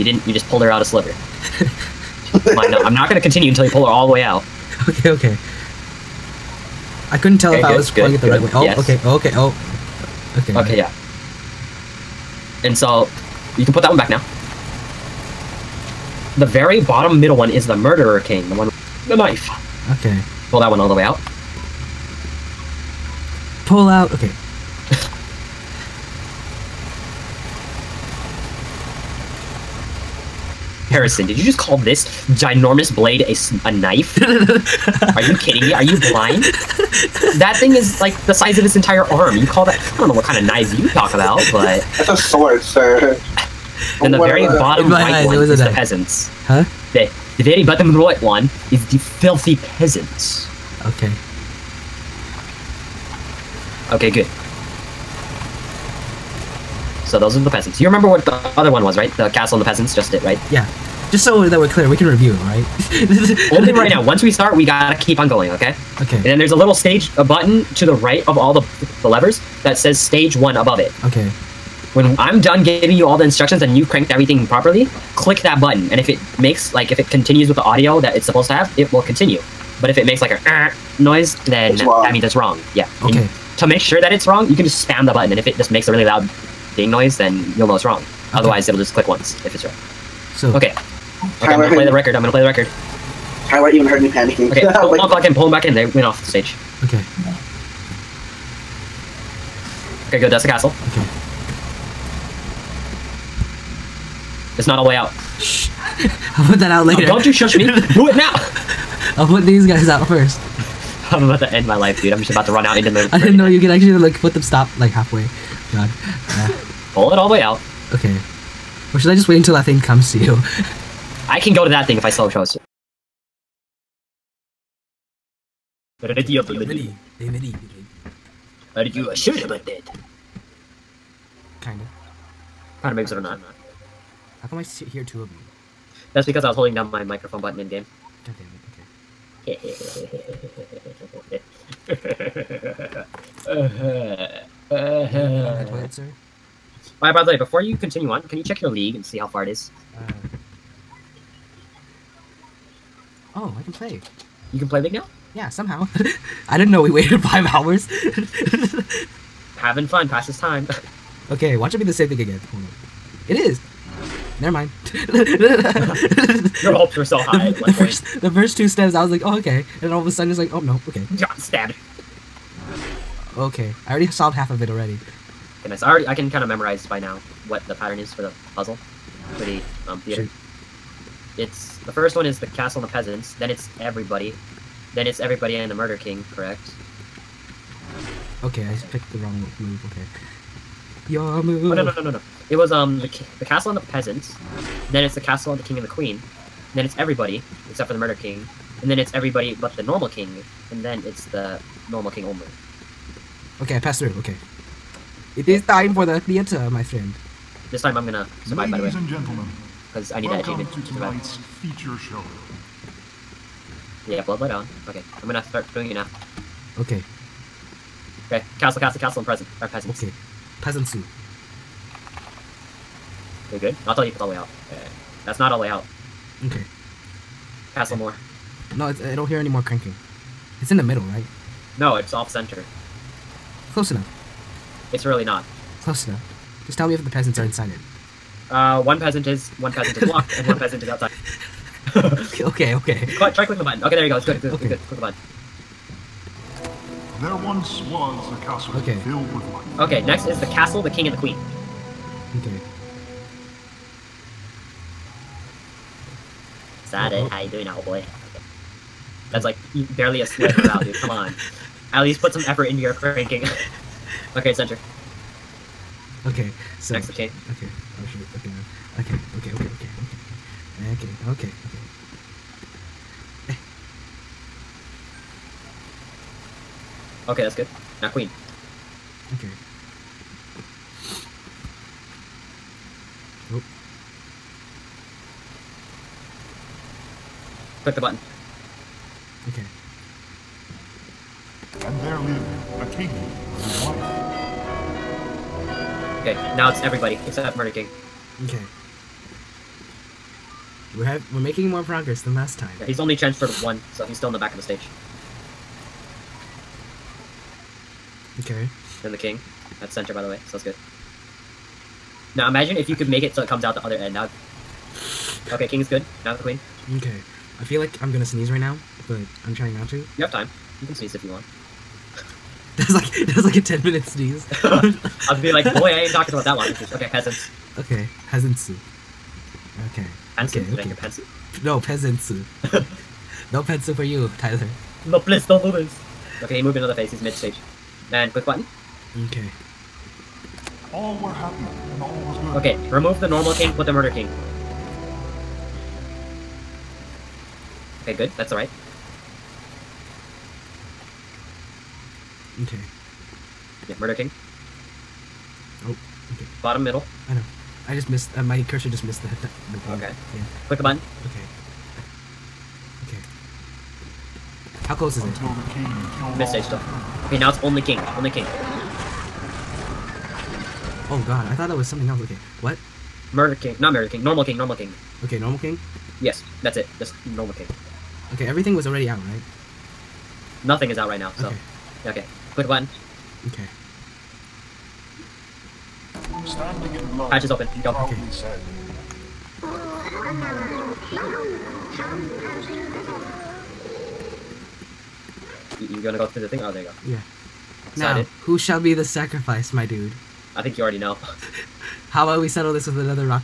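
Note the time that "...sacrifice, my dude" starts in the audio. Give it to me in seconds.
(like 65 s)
399 s.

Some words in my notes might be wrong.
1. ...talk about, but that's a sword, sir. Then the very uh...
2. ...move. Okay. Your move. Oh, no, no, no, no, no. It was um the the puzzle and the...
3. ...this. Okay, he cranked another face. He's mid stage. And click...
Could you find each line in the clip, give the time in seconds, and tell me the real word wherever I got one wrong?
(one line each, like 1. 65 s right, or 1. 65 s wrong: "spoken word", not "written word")
1. 40 s right
2. 189 s wrong: "castle", not "puzzle"
3. 335 s wrong: "moved", not "cranked".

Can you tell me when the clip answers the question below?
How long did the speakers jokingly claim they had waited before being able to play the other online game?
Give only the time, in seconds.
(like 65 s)
157 s.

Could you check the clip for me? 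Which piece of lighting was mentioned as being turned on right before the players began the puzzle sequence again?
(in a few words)
blood light.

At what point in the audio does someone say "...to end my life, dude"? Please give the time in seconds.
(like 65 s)
111 s.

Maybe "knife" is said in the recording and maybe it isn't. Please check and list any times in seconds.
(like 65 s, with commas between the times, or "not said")
19 s, 33 s.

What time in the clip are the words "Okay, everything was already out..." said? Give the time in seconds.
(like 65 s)
378 s.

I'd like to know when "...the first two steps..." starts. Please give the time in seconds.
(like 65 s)
168 s.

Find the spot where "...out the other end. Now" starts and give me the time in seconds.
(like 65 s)
313 s.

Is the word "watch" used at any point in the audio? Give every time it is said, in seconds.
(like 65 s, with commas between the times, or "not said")
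161 s.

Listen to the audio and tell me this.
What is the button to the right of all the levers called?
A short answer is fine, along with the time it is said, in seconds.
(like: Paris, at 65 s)
stage one, at 69 s.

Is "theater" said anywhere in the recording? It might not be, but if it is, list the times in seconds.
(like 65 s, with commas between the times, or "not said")
179 s, 206 s.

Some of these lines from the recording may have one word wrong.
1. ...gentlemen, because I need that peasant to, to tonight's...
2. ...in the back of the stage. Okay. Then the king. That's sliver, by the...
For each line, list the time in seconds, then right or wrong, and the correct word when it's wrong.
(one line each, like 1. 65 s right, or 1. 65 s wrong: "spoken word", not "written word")
1. 209 s wrong: "achievement", not "peasant"
2. 304 s wrong: "center", not "sliver".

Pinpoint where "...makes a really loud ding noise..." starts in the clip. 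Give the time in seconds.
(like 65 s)
85 s.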